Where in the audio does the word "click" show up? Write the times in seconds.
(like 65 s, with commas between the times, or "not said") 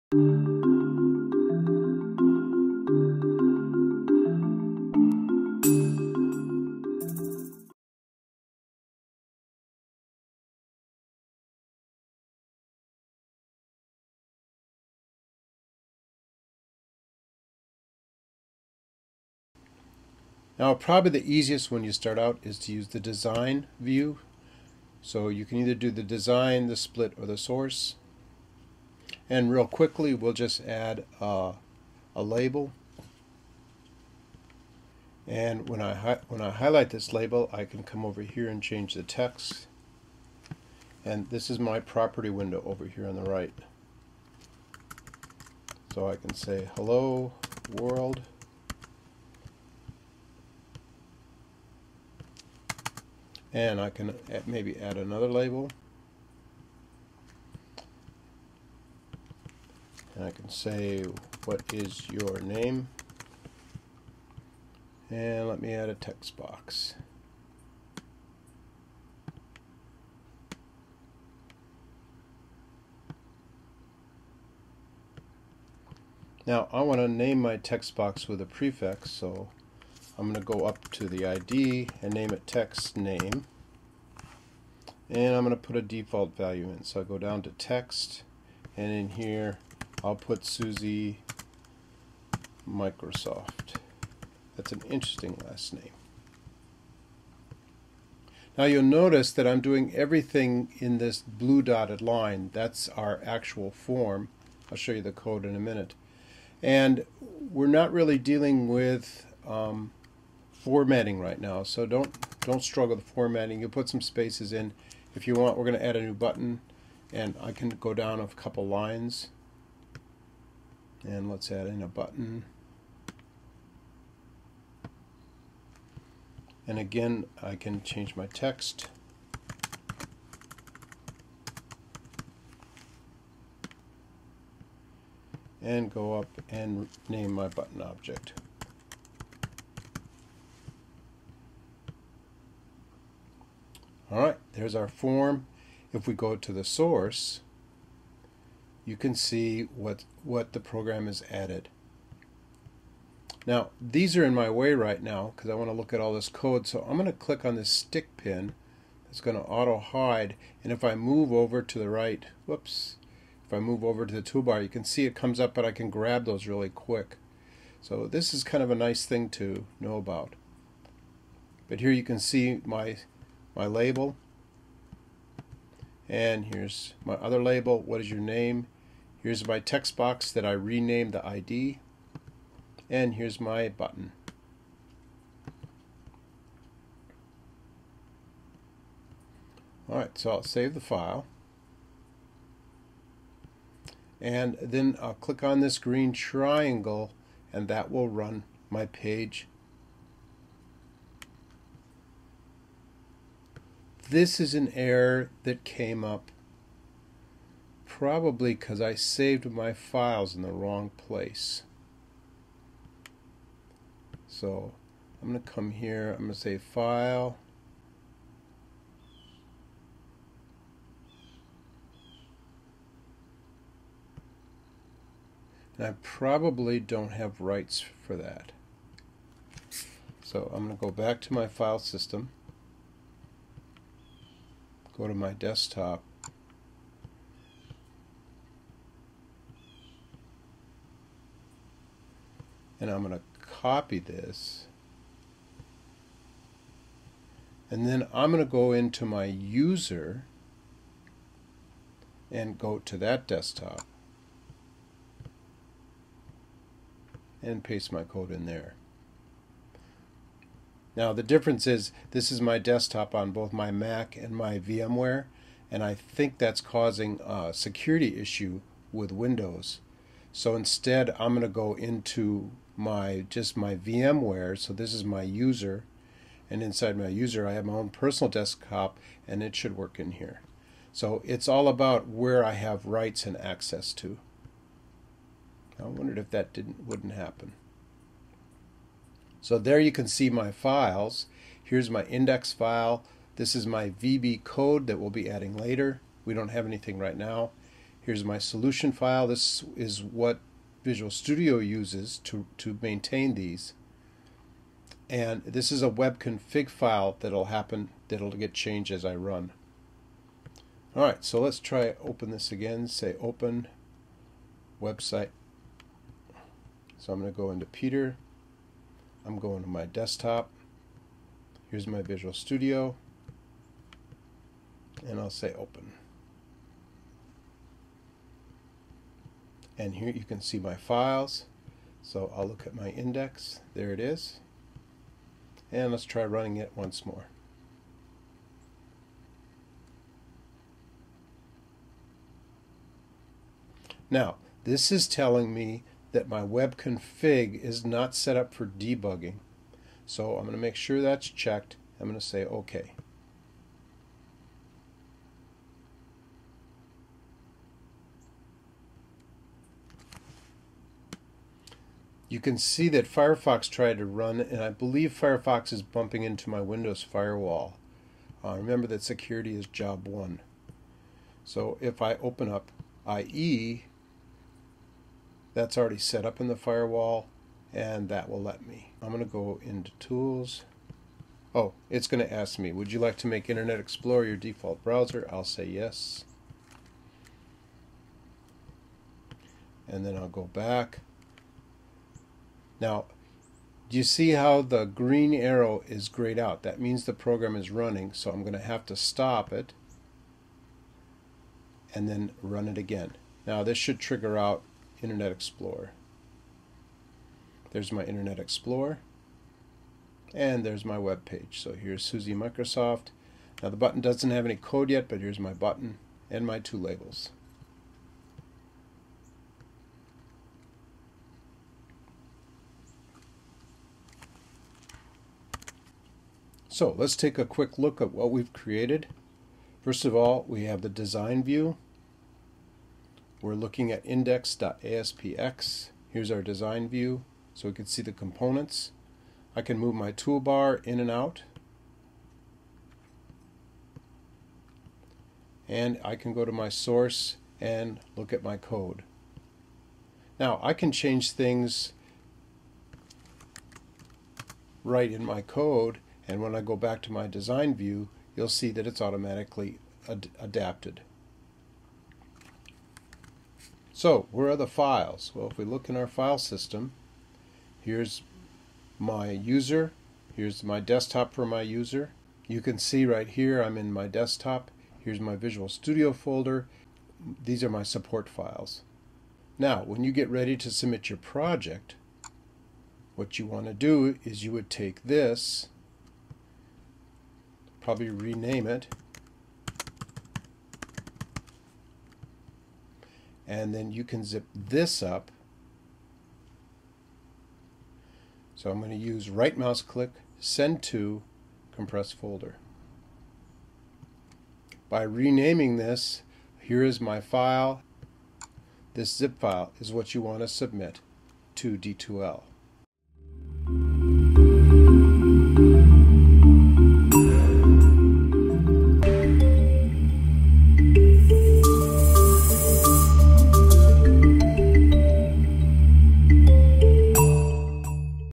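157 s, 195 s, 499 s.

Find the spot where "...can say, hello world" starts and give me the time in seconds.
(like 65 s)
46 s.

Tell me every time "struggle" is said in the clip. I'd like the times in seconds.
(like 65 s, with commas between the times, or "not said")
112 s.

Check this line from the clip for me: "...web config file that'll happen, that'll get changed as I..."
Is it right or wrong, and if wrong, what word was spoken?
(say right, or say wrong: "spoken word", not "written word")
right.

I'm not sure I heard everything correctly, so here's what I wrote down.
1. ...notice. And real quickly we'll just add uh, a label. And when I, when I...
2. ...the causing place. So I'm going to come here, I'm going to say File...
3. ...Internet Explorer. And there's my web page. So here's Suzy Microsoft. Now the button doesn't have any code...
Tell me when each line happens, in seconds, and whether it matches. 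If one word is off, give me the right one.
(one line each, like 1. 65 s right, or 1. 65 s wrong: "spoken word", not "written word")
1. 27 s wrong: "source", not "notice"
2. 210 s wrong: "wrong", not "causing"
3. 408 s right.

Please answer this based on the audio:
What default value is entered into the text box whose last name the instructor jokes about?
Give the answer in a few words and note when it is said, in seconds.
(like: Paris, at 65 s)
Susie Microsoft, at 90 s.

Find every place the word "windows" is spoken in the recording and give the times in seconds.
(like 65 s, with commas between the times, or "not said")
42 s, 269 s, 366 s.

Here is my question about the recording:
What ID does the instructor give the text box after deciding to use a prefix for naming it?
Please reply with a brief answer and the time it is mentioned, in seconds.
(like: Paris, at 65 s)
text name, at 82 s.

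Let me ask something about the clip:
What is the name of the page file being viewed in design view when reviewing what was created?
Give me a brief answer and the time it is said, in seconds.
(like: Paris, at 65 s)
index.aspx, at 434 s.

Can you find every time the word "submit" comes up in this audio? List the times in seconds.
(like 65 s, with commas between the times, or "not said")
480 s, 510 s.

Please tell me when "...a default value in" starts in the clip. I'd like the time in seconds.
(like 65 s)
85 s.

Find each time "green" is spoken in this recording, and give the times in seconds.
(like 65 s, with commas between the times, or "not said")
195 s, 394 s.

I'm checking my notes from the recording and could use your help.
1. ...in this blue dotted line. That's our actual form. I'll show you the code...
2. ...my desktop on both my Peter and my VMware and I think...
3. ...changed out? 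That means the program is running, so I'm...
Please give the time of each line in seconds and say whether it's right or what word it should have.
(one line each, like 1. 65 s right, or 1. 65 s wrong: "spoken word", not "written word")
1. 100 s right
2. 262 s wrong: "Mac", not "Peter"
3. 396 s wrong: "grayed", not "changed".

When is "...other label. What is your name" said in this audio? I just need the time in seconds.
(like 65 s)
177 s.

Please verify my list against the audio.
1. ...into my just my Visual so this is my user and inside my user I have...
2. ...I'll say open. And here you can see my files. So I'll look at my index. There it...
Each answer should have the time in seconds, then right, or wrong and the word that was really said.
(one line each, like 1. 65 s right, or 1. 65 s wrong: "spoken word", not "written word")
1. 271 s wrong: "VMware", not "Visual"
2. 325 s right.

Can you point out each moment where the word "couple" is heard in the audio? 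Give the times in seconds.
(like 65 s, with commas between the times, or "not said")
118 s.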